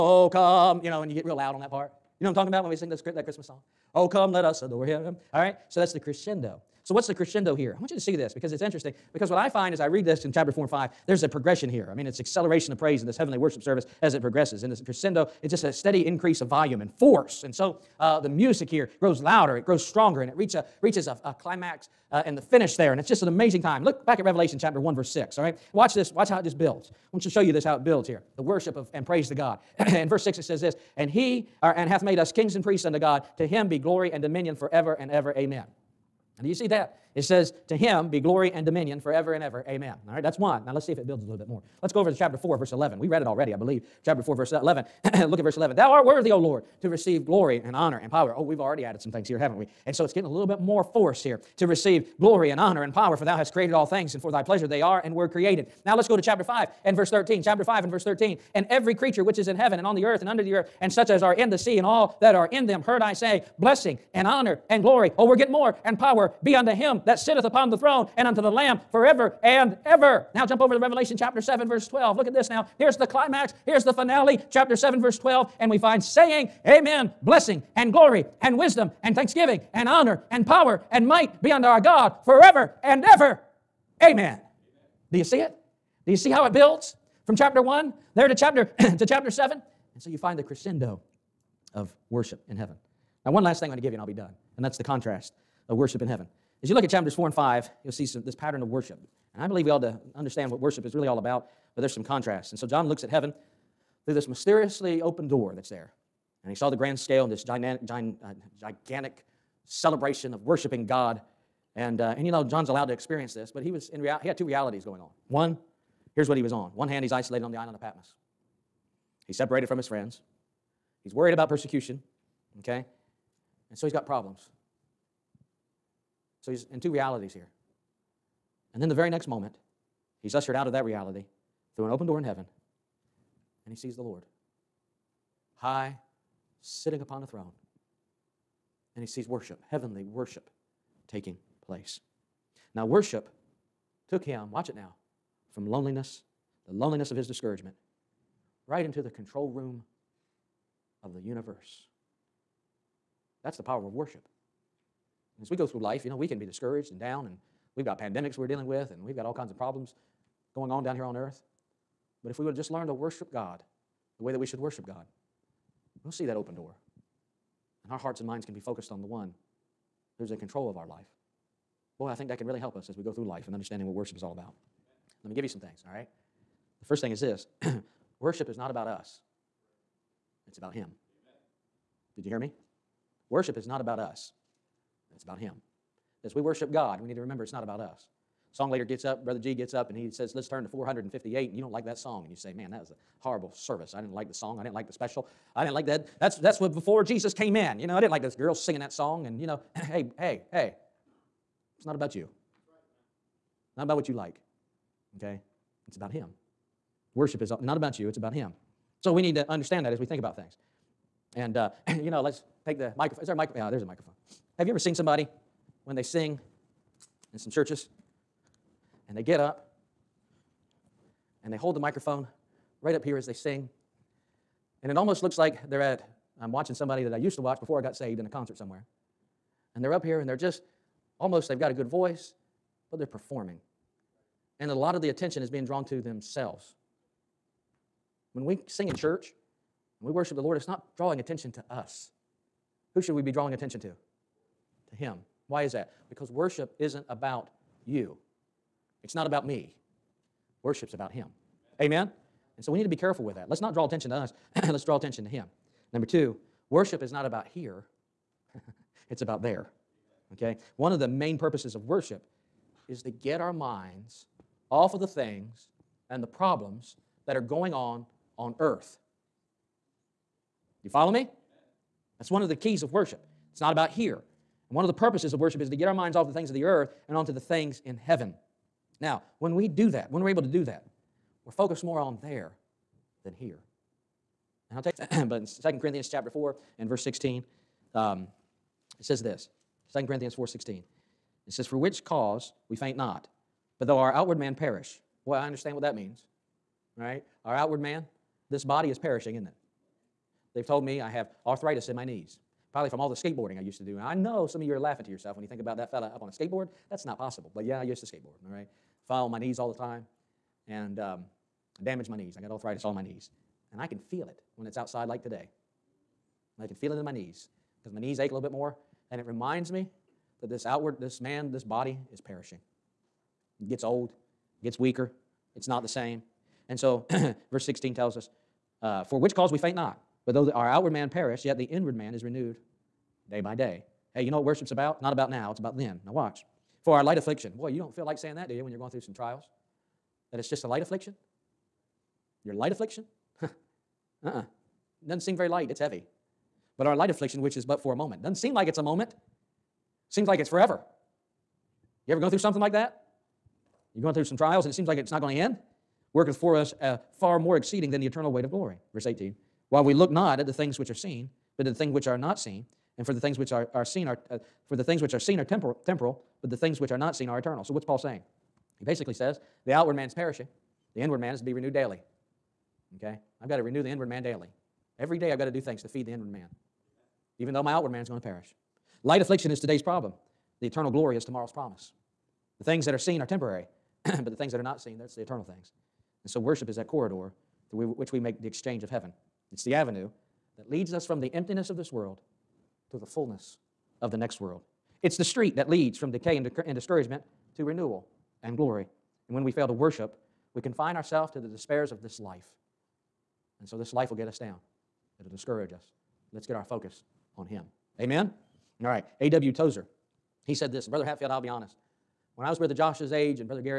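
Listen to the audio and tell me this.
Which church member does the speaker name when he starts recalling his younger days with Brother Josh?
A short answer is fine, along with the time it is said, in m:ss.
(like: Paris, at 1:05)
Brother Hatfield, at 6:50.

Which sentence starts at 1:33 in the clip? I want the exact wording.
Now one last thing I'm going to give you and I'll be done.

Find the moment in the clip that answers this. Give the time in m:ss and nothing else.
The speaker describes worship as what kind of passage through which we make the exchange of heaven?
6:26.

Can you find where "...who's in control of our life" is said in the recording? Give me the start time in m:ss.
2:50.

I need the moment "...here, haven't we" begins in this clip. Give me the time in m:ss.
0:49.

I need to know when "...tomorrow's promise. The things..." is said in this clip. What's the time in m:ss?
6:21.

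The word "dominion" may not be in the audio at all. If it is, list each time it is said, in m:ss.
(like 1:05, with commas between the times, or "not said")
0:34, 0:38.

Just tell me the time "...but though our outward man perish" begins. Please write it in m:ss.
4:53.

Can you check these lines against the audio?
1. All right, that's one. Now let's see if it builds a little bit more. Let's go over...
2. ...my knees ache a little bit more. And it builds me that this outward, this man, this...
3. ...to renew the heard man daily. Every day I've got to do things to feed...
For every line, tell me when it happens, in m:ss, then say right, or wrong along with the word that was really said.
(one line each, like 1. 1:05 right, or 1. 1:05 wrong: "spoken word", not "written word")
1. 0:40 right
2. 5:17 wrong: "reminds", not "builds"
3. 6:13 wrong: "inward", not "heard".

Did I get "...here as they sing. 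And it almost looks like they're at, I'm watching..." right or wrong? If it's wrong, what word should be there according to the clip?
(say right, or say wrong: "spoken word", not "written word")
right.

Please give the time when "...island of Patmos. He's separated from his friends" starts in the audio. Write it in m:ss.
1:57.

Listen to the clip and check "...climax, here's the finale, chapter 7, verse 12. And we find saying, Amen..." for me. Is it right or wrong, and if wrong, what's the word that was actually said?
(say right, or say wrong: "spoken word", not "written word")
right.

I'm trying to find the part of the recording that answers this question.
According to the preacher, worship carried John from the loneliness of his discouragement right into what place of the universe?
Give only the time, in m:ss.
2:29.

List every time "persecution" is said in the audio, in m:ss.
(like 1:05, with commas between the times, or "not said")
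2:01.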